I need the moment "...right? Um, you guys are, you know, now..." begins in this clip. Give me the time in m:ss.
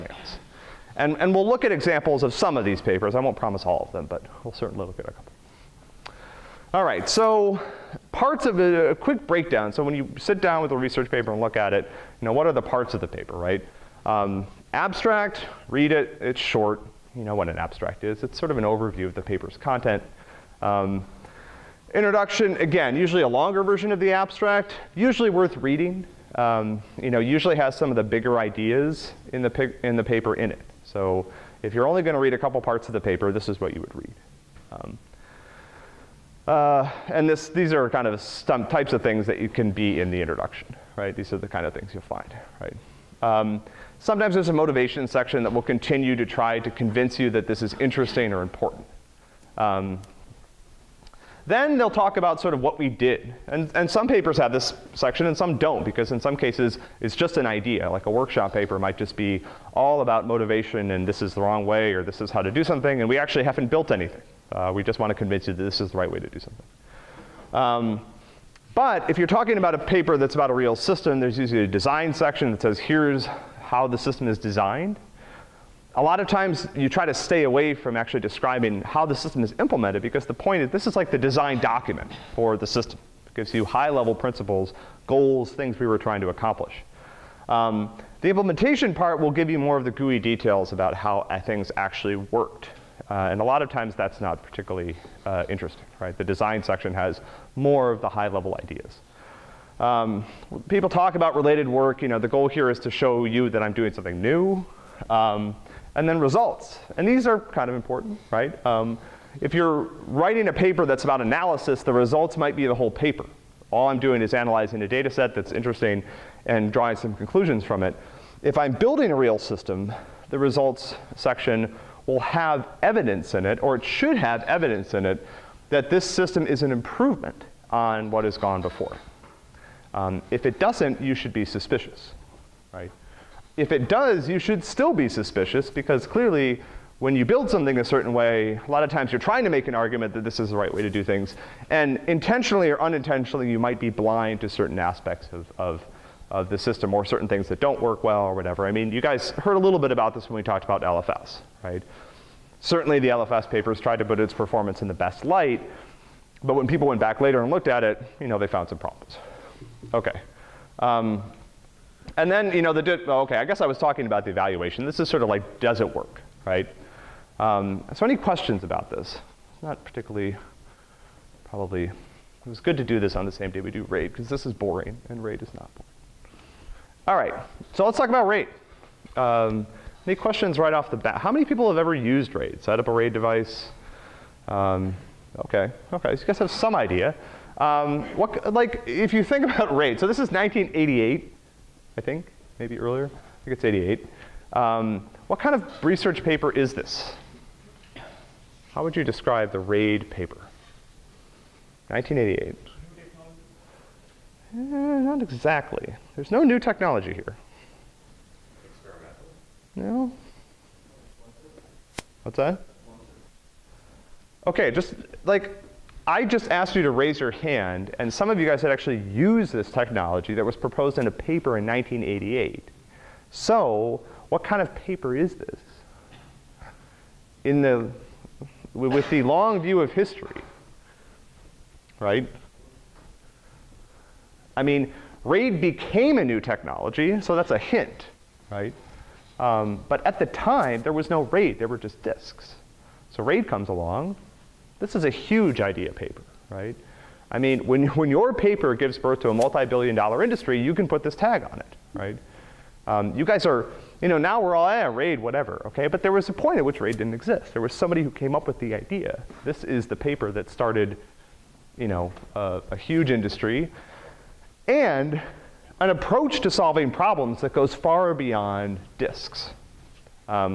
4:11.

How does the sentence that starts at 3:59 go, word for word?
Um, but at the time, there was no RAID, there were just disks.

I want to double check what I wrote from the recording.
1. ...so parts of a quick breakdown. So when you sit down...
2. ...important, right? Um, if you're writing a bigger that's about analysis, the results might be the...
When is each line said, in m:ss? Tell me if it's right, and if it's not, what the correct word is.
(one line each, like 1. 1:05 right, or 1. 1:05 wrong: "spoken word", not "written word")
1. 0:07 right
2. 1:47 wrong: "paper", not "bigger".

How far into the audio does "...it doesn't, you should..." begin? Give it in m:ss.
2:10.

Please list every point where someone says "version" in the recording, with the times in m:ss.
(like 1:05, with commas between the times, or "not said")
0:23.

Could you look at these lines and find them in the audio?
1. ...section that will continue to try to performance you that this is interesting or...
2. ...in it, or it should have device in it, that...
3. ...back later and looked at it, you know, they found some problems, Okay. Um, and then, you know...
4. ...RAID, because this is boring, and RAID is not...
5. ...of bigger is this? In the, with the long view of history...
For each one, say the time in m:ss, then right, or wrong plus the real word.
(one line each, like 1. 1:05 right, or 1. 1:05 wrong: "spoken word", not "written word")
1. 0:45 wrong: "convince", not "performance"
2. 2:03 wrong: "evidence", not "device"
3. 2:37 right
4. 2:53 right
5. 3:44 wrong: "paper", not "bigger".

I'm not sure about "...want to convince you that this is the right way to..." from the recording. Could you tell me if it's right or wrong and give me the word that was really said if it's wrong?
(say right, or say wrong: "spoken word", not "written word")
right.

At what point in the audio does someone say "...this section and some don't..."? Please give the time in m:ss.
0:54.